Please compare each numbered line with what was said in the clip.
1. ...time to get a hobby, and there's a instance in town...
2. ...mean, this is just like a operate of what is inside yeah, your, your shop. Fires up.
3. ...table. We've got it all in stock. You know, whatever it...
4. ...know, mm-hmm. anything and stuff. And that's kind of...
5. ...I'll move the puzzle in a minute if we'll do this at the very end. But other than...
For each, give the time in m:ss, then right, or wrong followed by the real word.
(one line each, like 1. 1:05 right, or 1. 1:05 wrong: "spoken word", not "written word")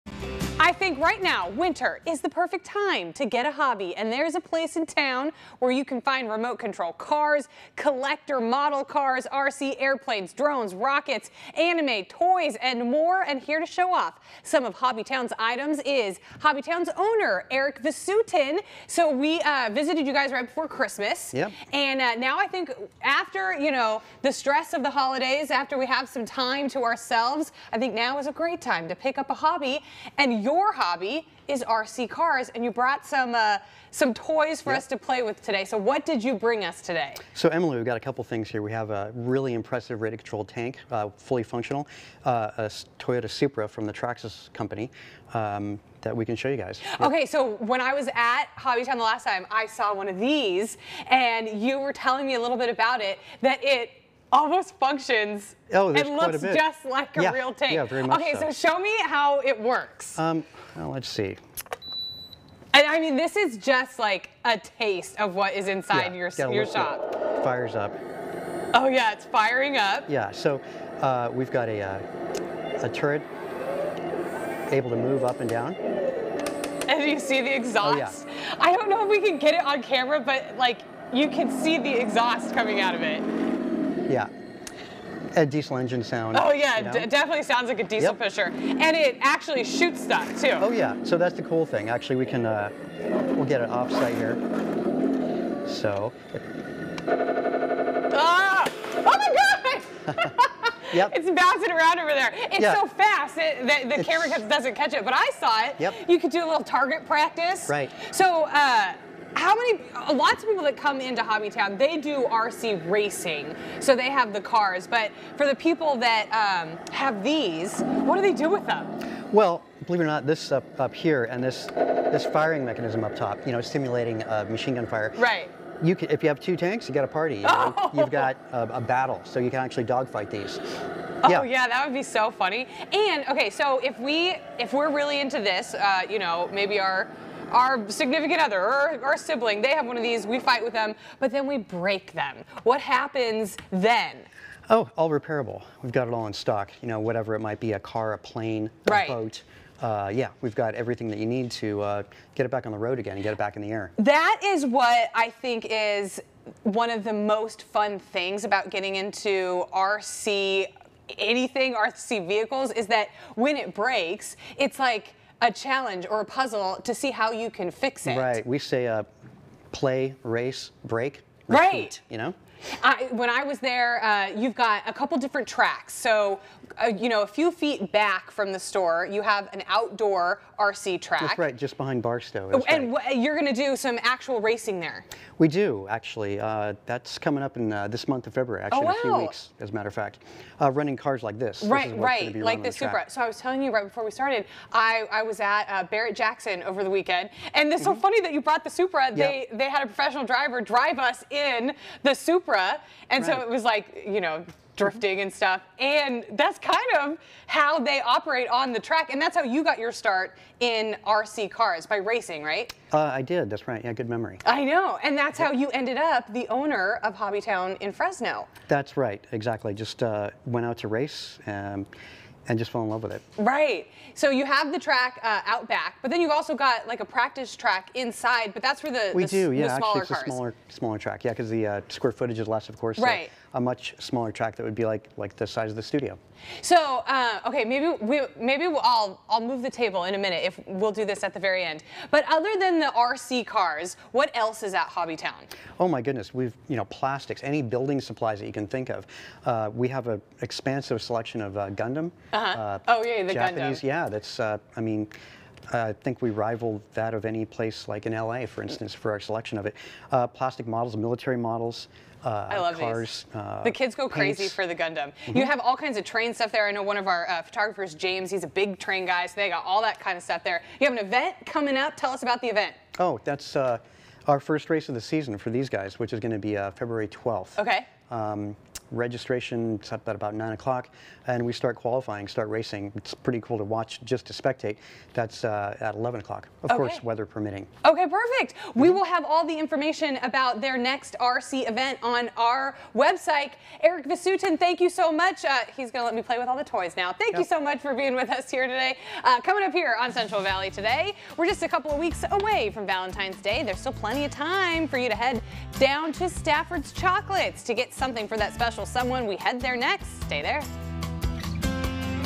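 1. 0:02 wrong: "place", not "instance"
2. 1:02 wrong: "taste", not "operate"
3. 2:25 wrong: "repairable", not "table"
4. 3:24 wrong: "drifting", not "anything"
5. 3:59 wrong: "table", not "puzzle".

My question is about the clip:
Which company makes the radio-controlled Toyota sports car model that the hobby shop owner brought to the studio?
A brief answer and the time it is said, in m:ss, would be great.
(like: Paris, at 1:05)
Traxxas, at 0:43.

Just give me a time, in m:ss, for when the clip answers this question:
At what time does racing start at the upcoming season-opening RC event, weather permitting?
4:45.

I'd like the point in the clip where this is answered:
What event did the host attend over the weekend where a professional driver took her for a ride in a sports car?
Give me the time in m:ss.
3:15.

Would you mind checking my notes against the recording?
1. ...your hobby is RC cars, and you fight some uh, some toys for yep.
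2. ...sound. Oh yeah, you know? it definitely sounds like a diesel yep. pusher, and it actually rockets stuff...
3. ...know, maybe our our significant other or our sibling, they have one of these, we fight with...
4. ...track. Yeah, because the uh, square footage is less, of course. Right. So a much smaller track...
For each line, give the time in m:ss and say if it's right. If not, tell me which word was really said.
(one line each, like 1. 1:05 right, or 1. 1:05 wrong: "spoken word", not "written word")
1. 0:30 wrong: "brought", not "fight"
2. 1:26 wrong: "shoots", not "rockets"
3. 2:16 right
4. 3:50 right.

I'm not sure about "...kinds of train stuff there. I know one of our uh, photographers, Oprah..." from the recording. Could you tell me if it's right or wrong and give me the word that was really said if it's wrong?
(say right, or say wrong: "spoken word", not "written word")
wrong: "James", not "Oprah".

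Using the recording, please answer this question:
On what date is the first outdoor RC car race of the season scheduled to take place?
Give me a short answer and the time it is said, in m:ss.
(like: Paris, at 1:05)
February 12th, at 4:36.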